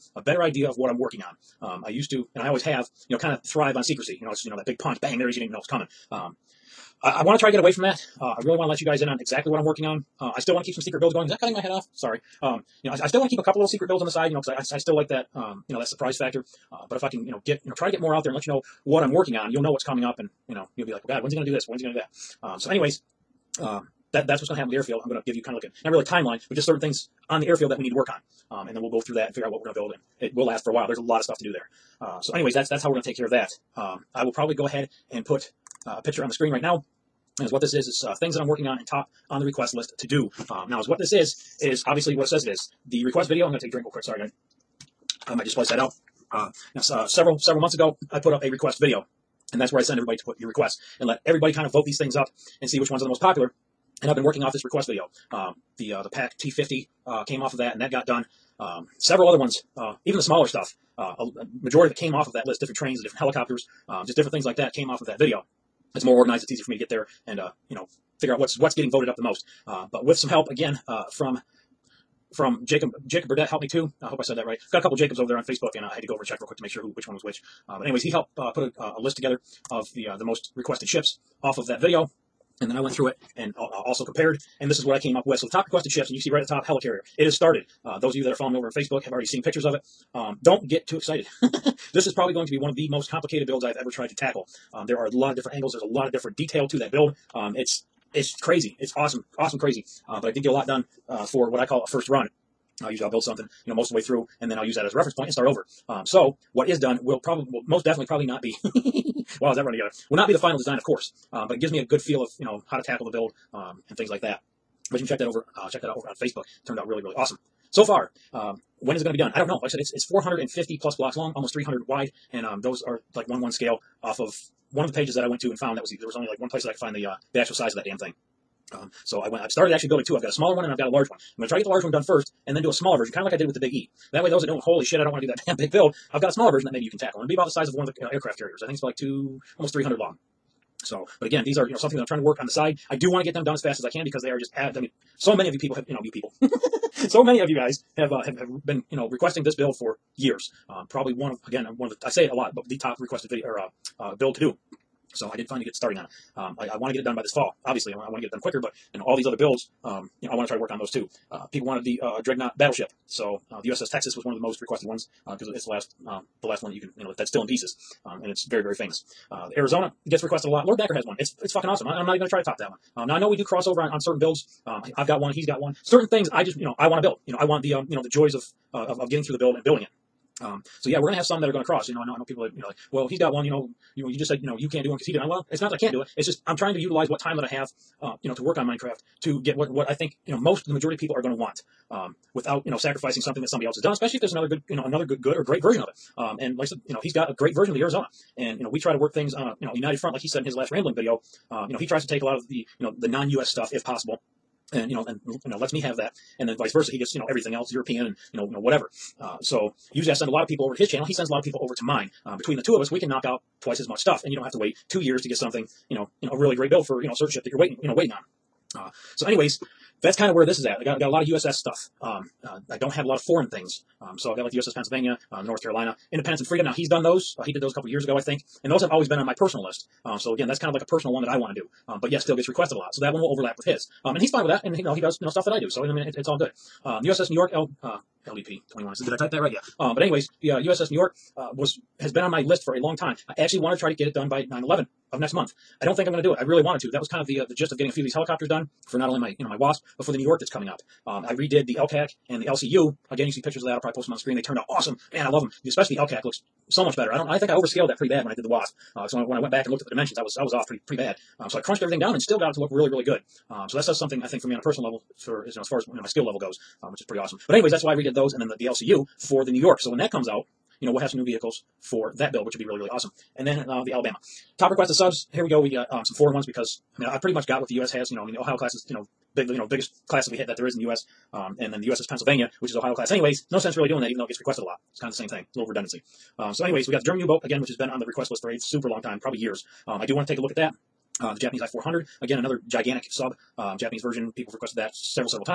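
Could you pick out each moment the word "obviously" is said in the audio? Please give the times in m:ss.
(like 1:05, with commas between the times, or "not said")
0:41, 2:37.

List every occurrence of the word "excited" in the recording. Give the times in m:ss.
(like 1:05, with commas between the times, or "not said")
1:30.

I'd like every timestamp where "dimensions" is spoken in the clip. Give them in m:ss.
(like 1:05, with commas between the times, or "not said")
4:19.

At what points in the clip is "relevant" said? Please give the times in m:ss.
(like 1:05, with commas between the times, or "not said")
not said.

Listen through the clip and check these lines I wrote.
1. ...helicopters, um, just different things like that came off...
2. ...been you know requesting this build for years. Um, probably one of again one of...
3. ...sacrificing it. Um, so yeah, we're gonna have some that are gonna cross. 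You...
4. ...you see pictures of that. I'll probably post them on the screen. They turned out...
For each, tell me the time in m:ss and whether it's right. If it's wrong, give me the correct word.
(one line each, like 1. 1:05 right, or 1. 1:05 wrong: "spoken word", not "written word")
1. 1:03 right
2. 2:28 right
3. 2:59 wrong: "building", not "sacrificing"
4. 4:13 right.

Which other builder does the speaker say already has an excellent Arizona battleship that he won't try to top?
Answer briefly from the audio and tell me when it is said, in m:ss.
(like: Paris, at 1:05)
Lord Dakr, at 2:50.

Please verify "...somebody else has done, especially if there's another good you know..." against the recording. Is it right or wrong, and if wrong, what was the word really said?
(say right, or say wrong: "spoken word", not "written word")
right.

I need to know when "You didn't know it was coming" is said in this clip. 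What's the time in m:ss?
0:05.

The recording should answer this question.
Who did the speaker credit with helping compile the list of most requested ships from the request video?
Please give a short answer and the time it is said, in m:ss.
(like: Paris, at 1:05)
Jacob Burdett, at 1:13.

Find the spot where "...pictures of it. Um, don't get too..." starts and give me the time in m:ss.
1:29.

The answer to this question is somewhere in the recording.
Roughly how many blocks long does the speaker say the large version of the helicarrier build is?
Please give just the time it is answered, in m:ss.
2:00.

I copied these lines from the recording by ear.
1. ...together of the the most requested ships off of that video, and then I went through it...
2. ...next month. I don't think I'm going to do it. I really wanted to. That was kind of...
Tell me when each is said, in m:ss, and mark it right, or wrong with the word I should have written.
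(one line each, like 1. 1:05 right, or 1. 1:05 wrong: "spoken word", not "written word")
1. 1:19 right
2. 4:05 right.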